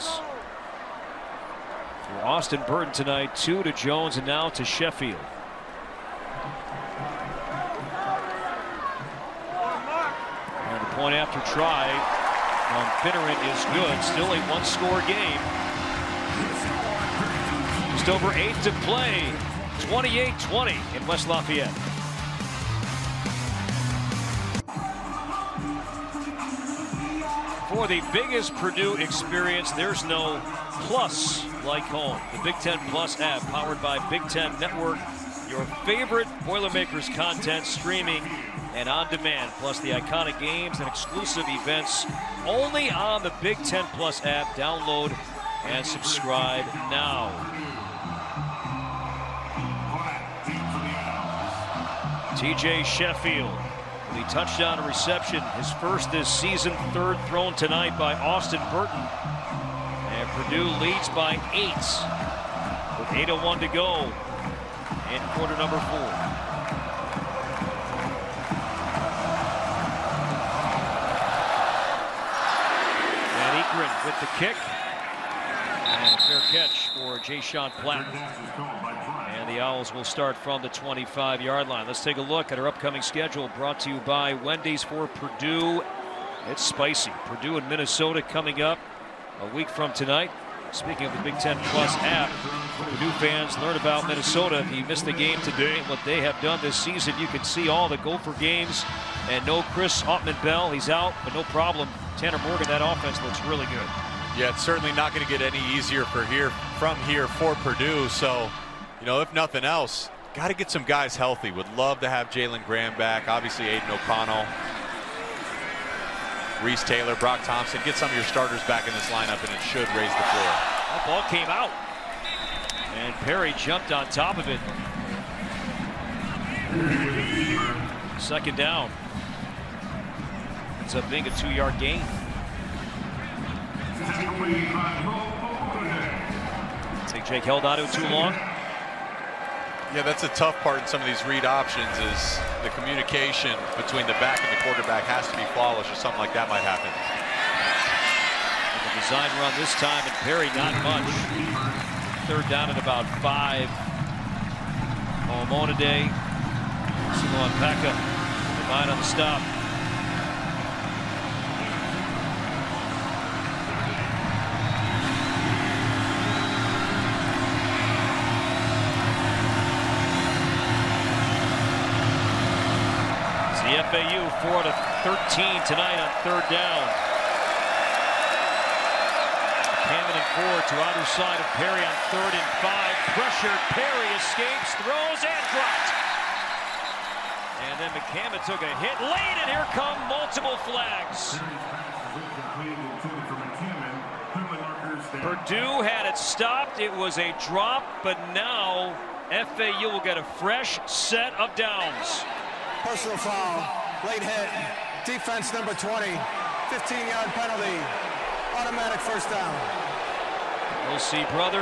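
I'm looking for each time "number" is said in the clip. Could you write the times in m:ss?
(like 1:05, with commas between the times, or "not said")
1:05, 3:25.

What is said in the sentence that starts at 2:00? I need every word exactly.
That ball came out, and Perry jumped on top of it.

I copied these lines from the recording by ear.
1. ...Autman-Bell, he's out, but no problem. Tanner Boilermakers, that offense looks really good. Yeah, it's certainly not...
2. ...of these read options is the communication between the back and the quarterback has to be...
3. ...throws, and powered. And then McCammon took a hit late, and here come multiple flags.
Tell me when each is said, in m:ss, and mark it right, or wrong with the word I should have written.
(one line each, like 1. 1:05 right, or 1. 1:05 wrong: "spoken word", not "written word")
1. 1:40 wrong: "Morgan", not "Boilermakers"
2. 2:21 right
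3. 3:04 wrong: "dropped", not "powered".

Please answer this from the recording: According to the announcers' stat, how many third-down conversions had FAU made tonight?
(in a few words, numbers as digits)
4.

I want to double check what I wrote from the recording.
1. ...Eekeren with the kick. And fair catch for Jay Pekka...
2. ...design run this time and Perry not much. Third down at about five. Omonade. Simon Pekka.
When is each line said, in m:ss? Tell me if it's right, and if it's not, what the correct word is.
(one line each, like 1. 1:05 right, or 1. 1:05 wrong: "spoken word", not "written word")
1. 1:13 wrong: "Sean", not "Pekka"
2. 2:29 right.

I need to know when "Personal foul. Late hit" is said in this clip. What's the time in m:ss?
3:22.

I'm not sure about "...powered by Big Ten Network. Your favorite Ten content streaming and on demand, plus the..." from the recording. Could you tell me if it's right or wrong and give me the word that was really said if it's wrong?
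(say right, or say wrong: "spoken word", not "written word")
wrong: "Boilermakers", not "Ten".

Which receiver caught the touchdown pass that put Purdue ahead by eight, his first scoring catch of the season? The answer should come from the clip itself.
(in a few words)
TJ Sheffield.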